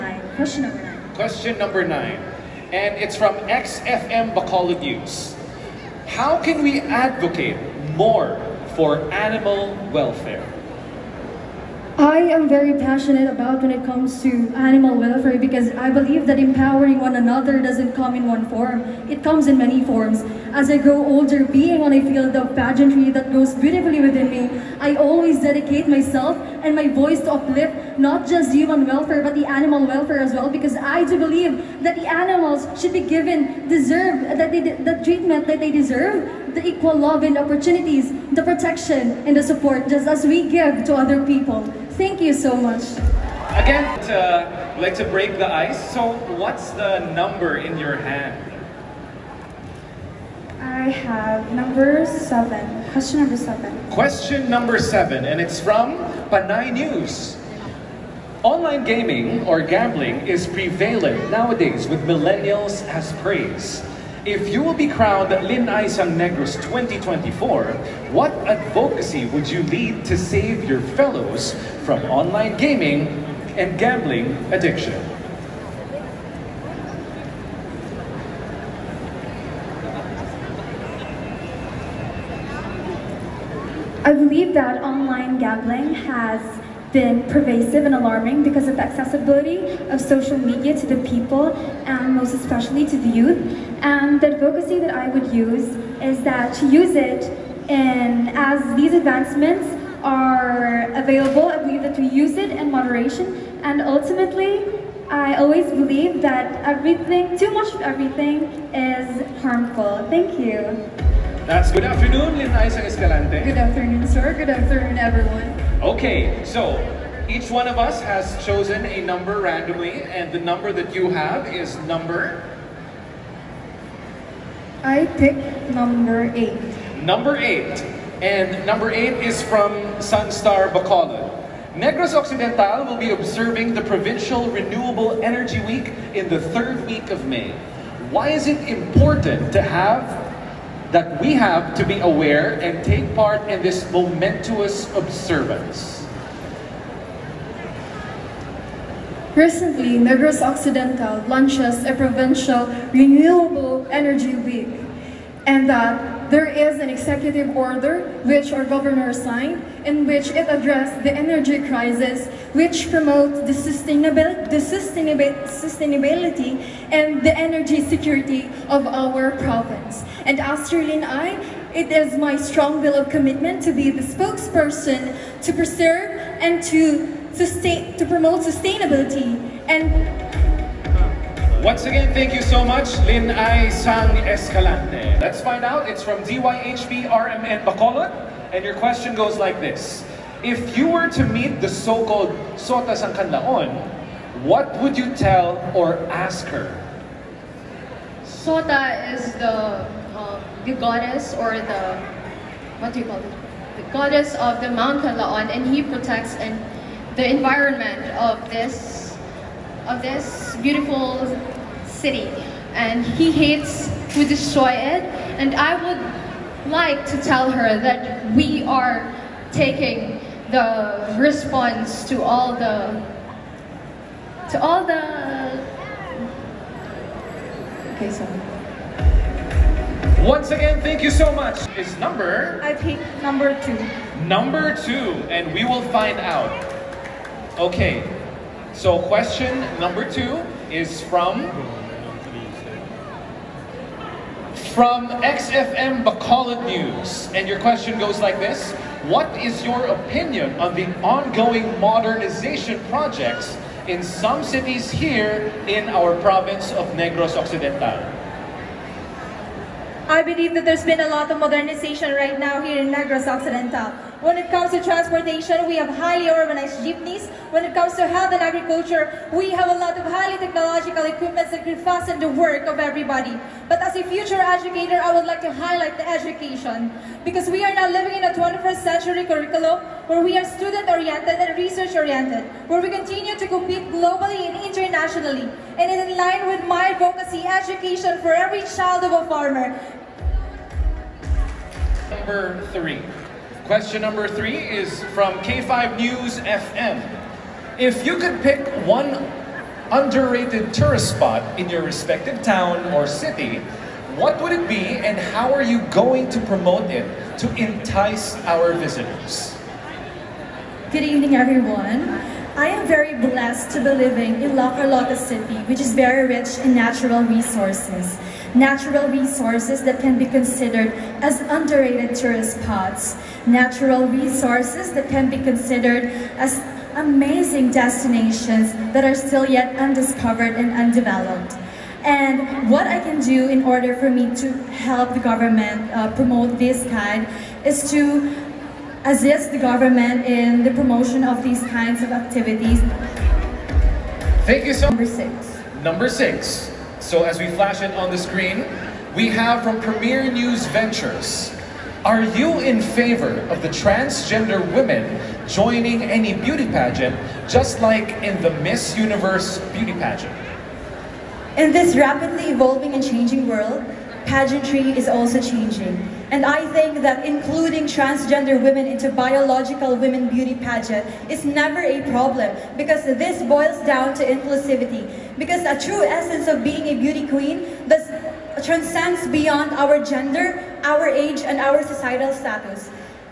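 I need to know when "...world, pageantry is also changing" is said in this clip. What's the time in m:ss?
6:03.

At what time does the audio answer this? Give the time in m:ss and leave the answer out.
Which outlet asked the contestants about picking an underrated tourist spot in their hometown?
4:55.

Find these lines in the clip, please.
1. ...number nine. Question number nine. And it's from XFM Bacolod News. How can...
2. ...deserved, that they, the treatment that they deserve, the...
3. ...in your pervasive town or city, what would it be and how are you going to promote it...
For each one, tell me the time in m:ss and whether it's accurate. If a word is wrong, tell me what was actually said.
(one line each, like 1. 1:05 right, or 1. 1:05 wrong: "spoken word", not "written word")
1. 0:00 right
2. 0:33 right
3. 5:01 wrong: "respective", not "pervasive".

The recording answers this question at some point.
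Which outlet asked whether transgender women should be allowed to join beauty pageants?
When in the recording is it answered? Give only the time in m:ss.
5:49.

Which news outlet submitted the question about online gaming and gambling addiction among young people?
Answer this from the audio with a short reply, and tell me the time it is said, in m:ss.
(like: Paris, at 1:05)
Panay News, at 0:56.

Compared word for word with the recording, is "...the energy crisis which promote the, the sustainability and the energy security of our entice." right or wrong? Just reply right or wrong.
wrong.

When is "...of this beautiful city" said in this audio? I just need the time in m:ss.
3:29.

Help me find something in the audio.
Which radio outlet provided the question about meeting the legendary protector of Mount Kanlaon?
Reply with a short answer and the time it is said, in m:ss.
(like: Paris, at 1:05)
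DYHB RMN Bacolod, at 3:06.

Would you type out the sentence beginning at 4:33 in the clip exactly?
But as a future educator, I would like to highlight the education.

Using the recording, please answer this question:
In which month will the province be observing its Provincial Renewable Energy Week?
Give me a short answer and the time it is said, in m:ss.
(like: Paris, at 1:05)
May, at 2:17.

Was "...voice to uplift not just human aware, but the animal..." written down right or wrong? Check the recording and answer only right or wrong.
wrong.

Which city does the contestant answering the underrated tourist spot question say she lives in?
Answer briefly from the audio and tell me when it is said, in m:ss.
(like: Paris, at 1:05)
Carlota City, at 5:14.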